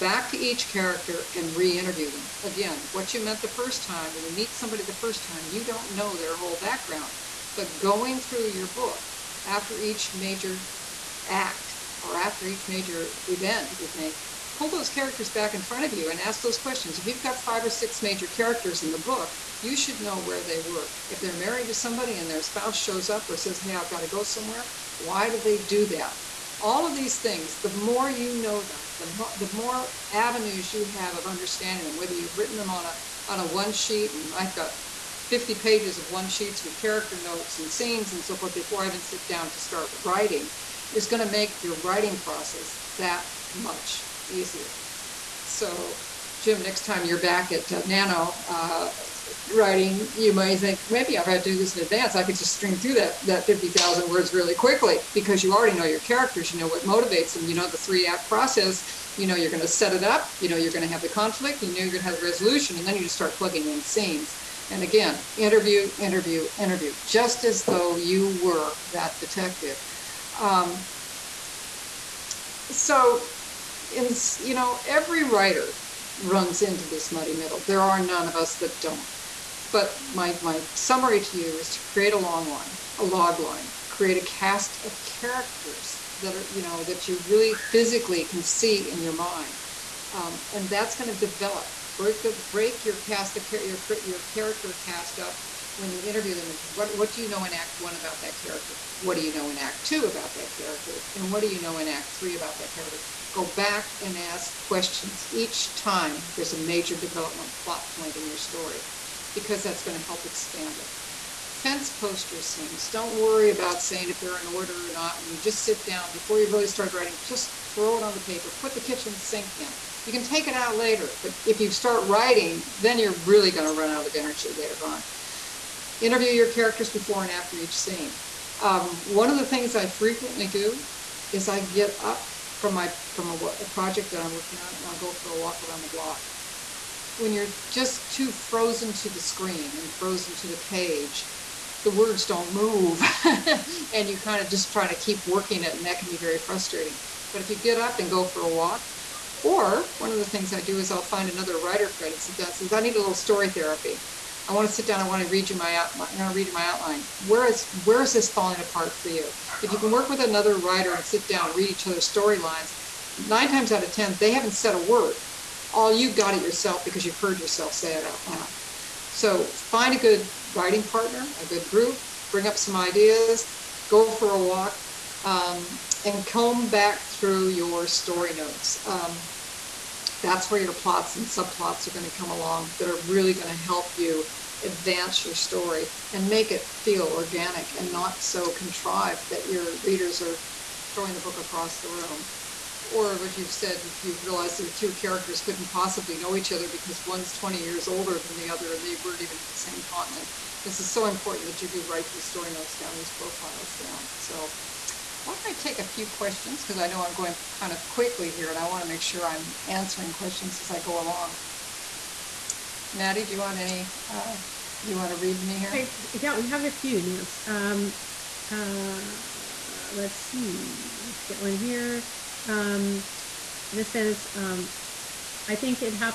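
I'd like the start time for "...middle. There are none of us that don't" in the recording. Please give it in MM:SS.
01:17.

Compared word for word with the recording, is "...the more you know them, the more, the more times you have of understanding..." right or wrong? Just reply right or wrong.
wrong.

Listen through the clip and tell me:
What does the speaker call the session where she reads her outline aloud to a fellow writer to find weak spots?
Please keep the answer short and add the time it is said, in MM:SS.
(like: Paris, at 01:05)
story therapy, at 02:33.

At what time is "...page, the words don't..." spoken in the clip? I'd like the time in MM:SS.
02:20.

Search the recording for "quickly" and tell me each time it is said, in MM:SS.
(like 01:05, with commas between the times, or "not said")
00:54, 03:27.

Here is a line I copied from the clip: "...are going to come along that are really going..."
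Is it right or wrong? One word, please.
right.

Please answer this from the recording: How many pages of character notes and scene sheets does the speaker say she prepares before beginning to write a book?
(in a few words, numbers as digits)
50.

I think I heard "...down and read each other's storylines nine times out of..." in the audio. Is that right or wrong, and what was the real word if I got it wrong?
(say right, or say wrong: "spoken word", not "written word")
right.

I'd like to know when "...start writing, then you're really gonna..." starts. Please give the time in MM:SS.
02:01.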